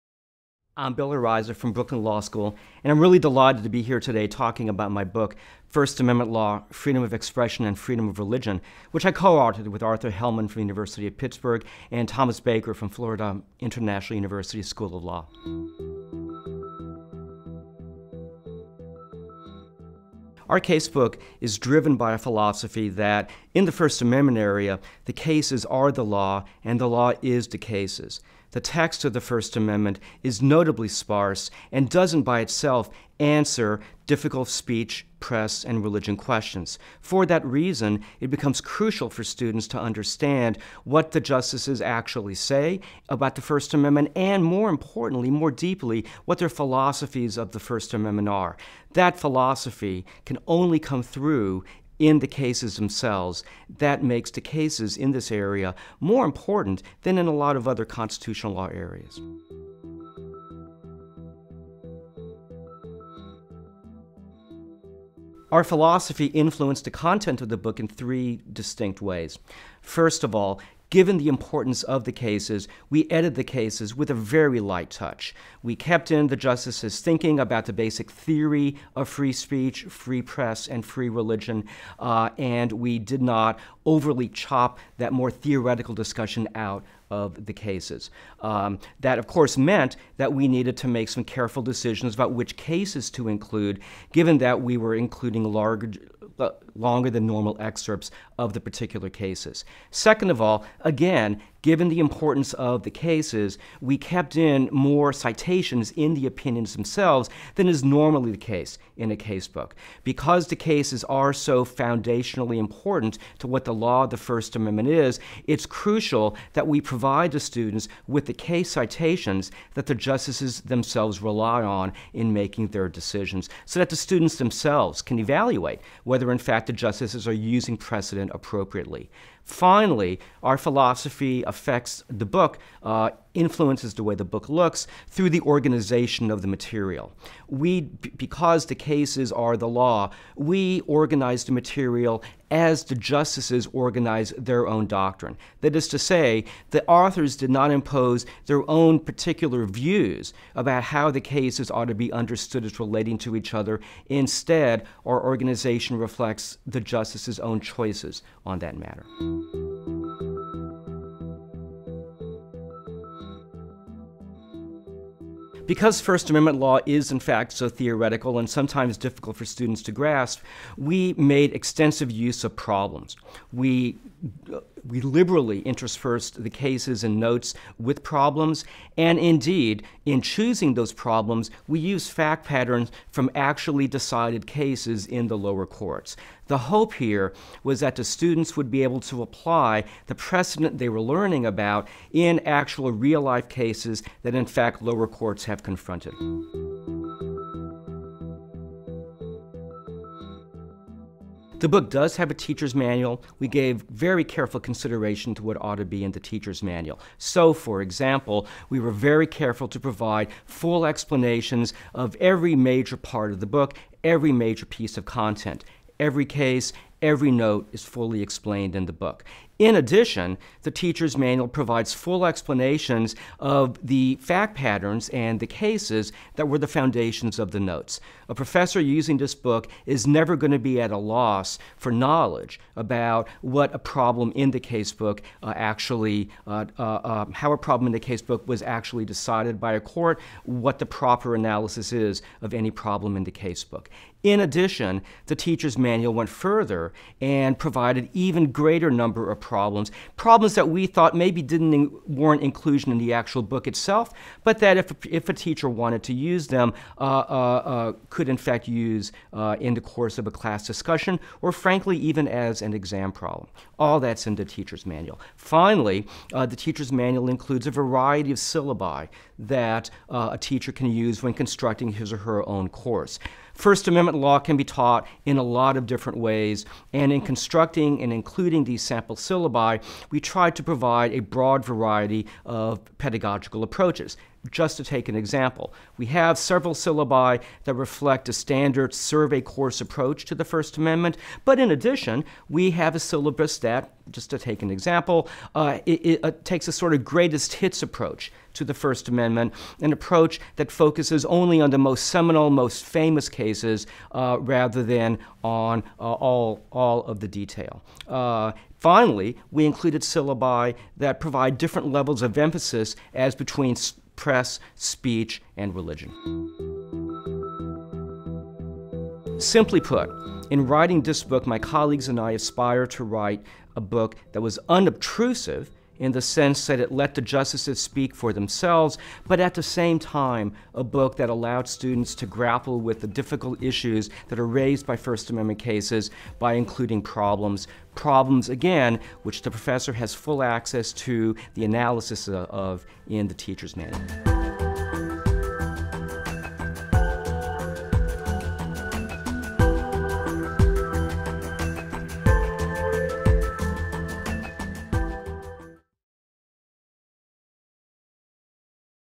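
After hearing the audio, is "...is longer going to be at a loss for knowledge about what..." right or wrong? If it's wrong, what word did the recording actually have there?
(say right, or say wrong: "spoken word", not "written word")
wrong: "never", not "longer".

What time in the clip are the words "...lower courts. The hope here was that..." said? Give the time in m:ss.
3:05.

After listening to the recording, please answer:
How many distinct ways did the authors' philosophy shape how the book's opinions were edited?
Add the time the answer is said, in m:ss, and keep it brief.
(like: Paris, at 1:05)
3, at 1:07.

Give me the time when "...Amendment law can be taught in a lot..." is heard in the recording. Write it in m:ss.
4:33.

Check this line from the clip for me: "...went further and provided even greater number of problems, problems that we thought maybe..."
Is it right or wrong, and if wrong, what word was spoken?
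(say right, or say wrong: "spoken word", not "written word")
right.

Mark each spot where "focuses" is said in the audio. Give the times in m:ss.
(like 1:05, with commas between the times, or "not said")
5:00.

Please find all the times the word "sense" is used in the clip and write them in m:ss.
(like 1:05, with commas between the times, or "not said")
5:26.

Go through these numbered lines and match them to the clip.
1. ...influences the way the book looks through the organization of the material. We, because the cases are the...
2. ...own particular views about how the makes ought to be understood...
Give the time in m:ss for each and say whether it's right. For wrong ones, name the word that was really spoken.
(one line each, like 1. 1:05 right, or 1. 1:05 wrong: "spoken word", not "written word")
1. 2:13 right
2. 2:28 wrong: "cases", not "makes".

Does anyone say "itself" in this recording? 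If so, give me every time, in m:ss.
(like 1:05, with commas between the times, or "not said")
0:32, 4:13.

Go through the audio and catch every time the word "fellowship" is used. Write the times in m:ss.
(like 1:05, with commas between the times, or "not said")
not said.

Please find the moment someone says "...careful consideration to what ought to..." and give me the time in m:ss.
3:24.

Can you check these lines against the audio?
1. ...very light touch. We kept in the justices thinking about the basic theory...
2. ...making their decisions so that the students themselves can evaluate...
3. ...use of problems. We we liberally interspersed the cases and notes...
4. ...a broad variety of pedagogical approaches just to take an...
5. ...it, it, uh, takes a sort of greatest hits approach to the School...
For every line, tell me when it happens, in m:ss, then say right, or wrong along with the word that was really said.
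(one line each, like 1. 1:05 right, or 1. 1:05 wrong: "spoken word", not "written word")
1. 1:14 right
2. 2:02 right
3. 2:52 right
4. 4:41 right
5. 4:55 wrong: "First", not "School".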